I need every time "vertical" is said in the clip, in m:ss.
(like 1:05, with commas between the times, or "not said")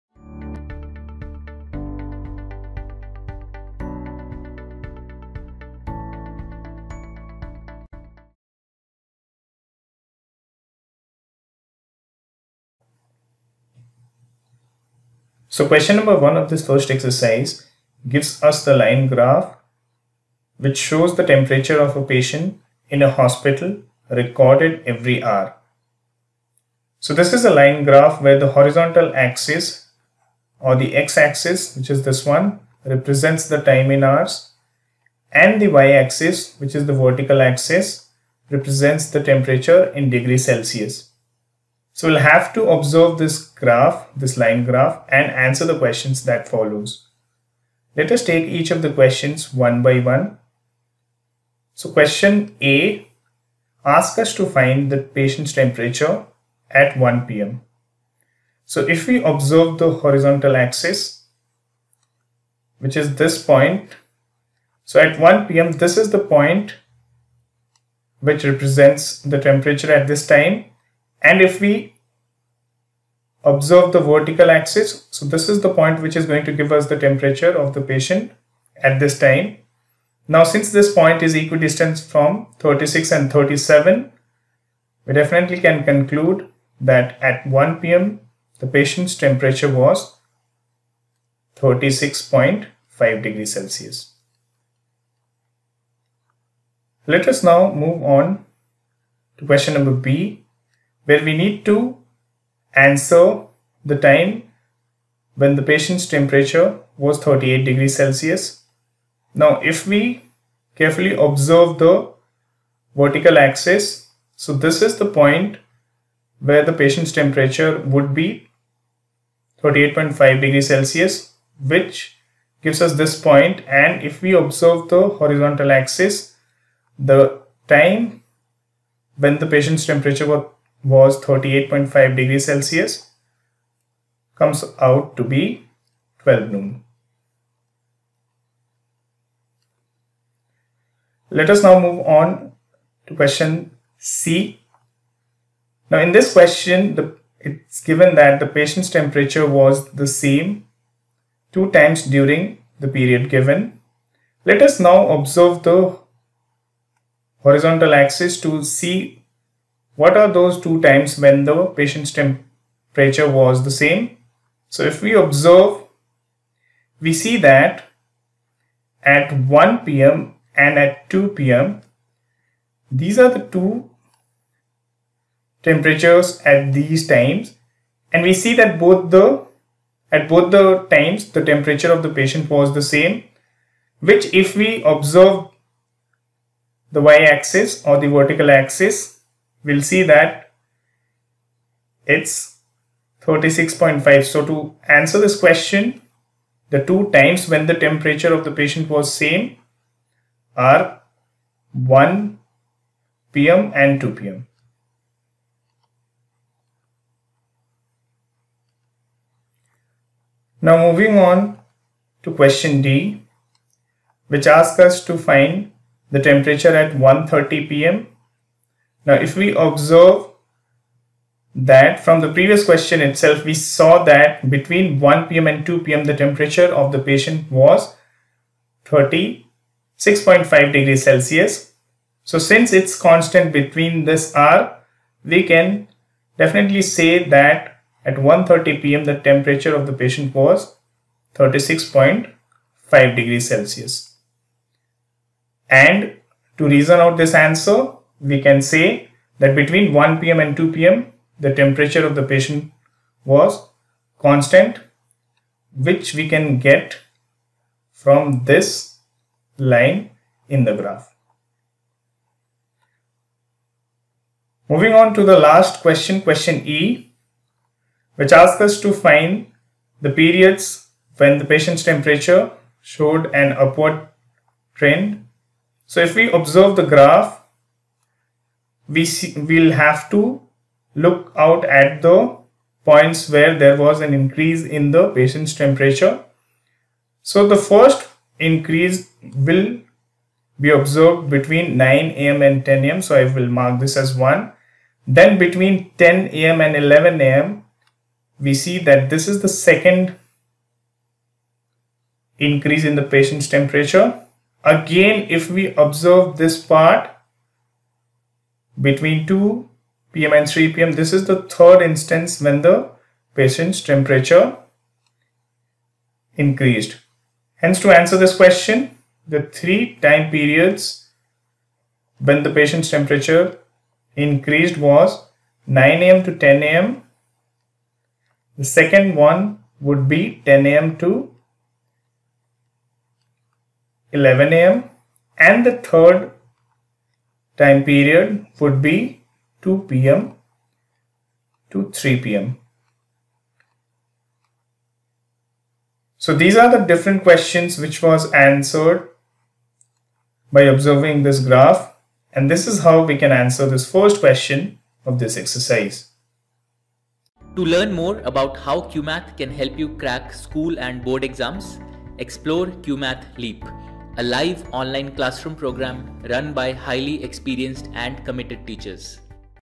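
0:36, 1:13, 1:52, 3:08.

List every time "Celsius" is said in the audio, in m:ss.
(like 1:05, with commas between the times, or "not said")
0:40, 1:33, 1:47, 2:00, 2:12, 3:51, 4:03.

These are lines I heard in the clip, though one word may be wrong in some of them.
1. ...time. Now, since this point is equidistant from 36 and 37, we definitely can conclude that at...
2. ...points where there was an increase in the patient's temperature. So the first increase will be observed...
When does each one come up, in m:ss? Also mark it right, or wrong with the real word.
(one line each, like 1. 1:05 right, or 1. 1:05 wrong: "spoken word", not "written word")
1. 1:19 right
2. 4:42 right.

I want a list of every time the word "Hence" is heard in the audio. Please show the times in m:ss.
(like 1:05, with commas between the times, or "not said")
5:17.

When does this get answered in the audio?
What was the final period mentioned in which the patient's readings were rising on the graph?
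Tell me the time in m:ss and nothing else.
5:39.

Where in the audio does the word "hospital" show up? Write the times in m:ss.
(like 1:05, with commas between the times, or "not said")
0:23.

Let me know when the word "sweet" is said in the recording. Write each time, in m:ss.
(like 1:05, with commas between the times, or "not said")
not said.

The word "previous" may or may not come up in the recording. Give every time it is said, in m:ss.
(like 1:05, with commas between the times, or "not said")
3:42.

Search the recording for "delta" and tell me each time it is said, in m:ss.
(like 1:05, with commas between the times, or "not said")
not said.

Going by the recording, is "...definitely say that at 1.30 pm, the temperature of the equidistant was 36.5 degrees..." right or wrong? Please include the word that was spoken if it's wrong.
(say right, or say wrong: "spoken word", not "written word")
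wrong: "patient", not "equidistant".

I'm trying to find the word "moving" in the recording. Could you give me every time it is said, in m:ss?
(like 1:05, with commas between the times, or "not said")
3:30, 4:24.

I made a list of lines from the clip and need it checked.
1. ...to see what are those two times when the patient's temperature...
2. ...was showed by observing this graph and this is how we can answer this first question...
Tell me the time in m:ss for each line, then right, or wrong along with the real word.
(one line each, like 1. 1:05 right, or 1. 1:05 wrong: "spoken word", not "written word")
1. 2:38 right
2. 5:48 wrong: "answered", not "showed".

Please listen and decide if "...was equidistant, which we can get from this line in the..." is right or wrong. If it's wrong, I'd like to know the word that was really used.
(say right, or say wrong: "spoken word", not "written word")
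wrong: "constant", not "equidistant".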